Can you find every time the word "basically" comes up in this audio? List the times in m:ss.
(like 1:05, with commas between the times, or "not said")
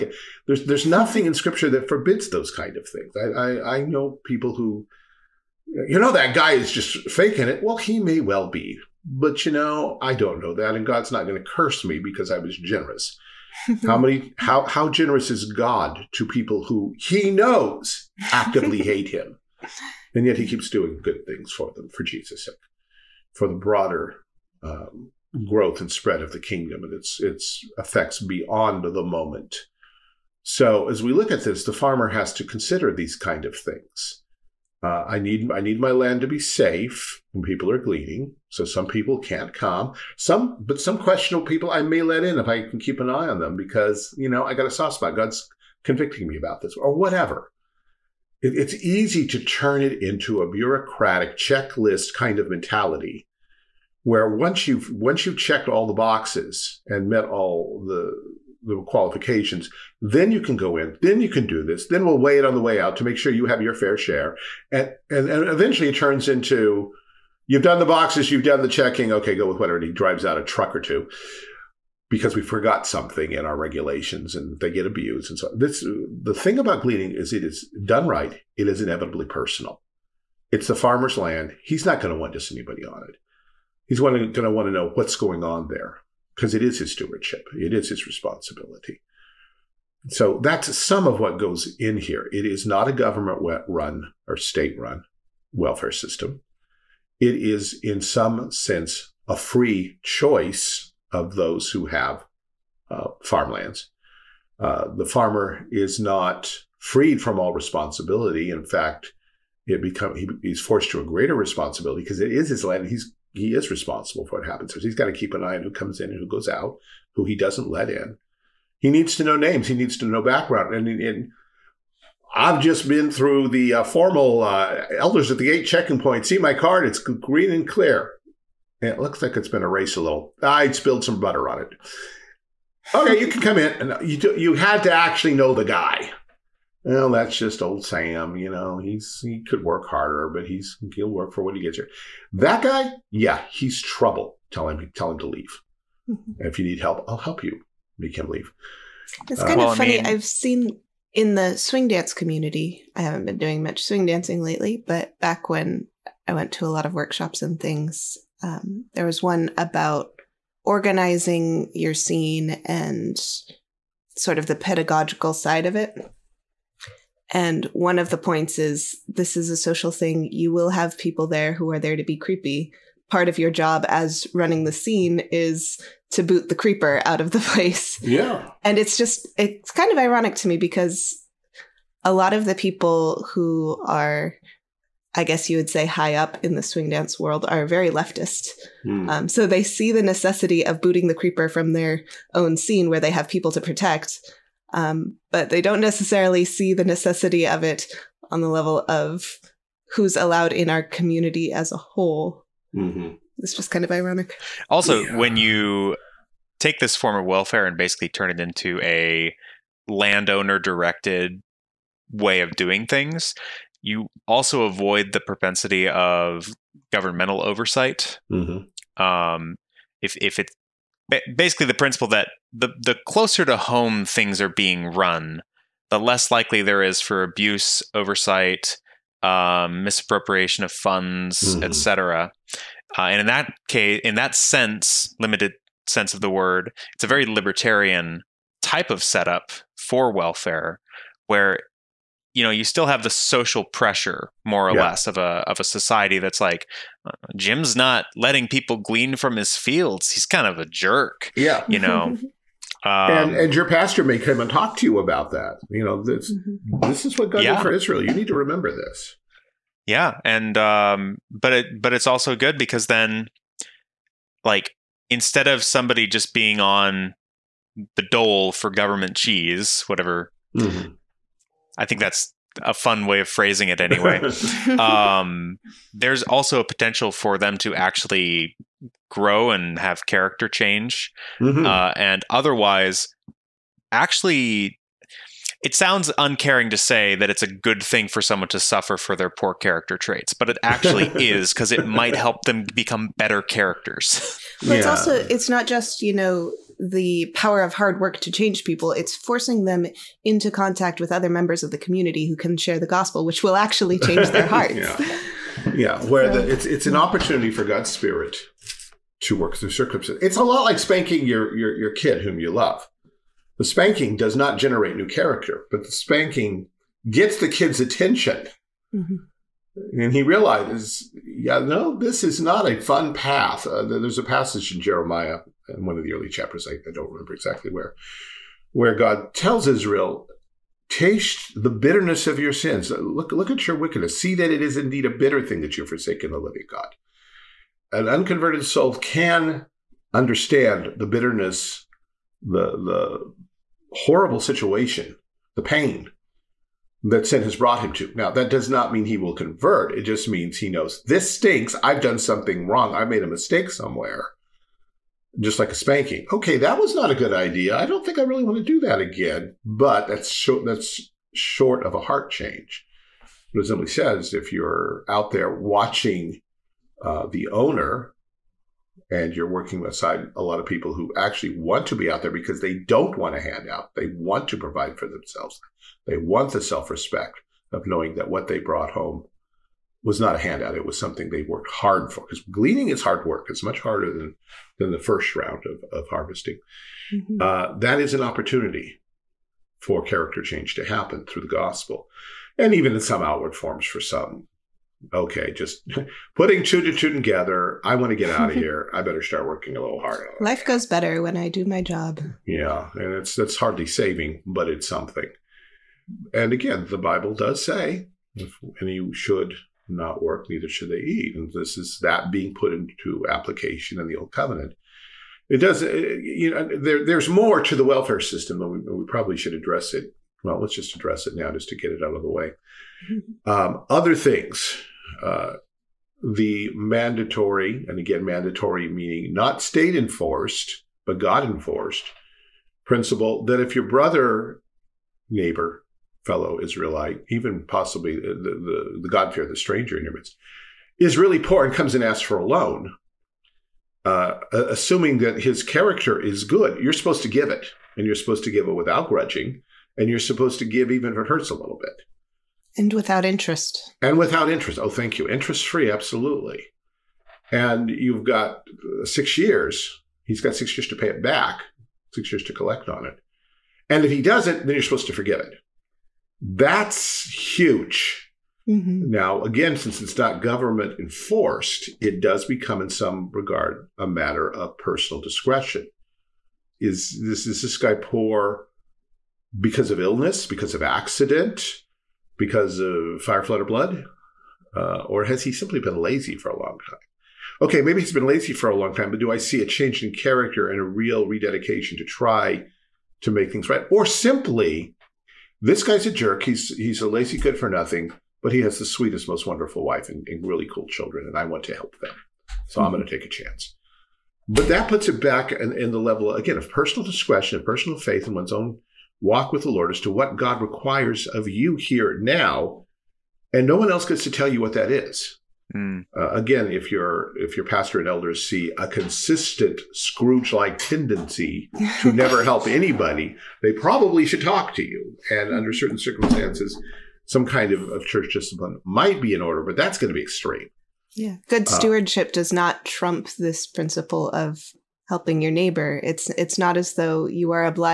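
3:27, 3:41.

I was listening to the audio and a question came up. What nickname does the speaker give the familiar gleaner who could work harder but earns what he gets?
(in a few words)
old Sam.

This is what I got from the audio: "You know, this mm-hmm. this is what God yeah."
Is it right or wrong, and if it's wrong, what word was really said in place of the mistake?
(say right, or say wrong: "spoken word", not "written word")
right.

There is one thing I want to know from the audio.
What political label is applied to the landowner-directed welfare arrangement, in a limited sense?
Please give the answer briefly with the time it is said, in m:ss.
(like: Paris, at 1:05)
libertarian, at 3:57.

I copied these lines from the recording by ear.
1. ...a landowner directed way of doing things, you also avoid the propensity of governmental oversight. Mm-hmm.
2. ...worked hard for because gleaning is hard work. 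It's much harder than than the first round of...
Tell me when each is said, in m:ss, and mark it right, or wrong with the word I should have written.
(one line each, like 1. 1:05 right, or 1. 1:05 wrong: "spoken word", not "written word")
1. 3:28 right
2. 6:21 right.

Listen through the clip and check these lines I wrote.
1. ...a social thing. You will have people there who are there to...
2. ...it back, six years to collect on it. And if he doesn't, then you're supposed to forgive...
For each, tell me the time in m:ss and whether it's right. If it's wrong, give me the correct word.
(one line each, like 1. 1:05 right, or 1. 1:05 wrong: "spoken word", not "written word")
1. 2:49 right
2. 7:41 right.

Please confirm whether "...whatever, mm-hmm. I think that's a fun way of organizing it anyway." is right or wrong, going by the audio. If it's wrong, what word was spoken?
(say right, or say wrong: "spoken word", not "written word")
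wrong: "phrasing", not "organizing".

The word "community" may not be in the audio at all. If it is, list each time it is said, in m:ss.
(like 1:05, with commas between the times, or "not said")
2:32, 3:20, 5:01.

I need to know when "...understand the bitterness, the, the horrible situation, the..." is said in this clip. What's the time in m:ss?
5:40.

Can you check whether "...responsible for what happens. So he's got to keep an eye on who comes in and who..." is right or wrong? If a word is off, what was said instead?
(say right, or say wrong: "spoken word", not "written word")
right.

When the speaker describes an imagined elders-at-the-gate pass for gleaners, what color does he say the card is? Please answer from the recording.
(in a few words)
green.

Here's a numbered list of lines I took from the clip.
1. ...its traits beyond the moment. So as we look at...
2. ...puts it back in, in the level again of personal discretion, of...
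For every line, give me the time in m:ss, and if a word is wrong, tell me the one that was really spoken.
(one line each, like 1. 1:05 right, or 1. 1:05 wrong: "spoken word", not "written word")
1. 0:27 wrong: "effects", not "traits"
2. 8:24 right.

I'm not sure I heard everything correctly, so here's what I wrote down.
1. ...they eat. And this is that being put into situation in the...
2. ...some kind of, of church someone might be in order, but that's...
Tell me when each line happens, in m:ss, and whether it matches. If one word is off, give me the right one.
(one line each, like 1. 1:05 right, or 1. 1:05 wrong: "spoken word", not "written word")
1. 6:50 wrong: "application", not "situation"
2. 8:47 wrong: "discipline", not "someone".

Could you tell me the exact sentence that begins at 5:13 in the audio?
The spanking does not generate new character, but the spanking gets the kid's attention.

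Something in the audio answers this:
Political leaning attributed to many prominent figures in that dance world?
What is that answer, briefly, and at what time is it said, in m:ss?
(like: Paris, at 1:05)
leftist, at 3:07.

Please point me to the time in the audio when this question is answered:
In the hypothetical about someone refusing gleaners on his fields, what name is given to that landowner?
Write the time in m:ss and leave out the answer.
4:07.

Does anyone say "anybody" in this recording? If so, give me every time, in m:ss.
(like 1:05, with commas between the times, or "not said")
1:22, 8:42.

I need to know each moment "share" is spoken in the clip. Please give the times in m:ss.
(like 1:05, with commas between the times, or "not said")
1:03, 5:02.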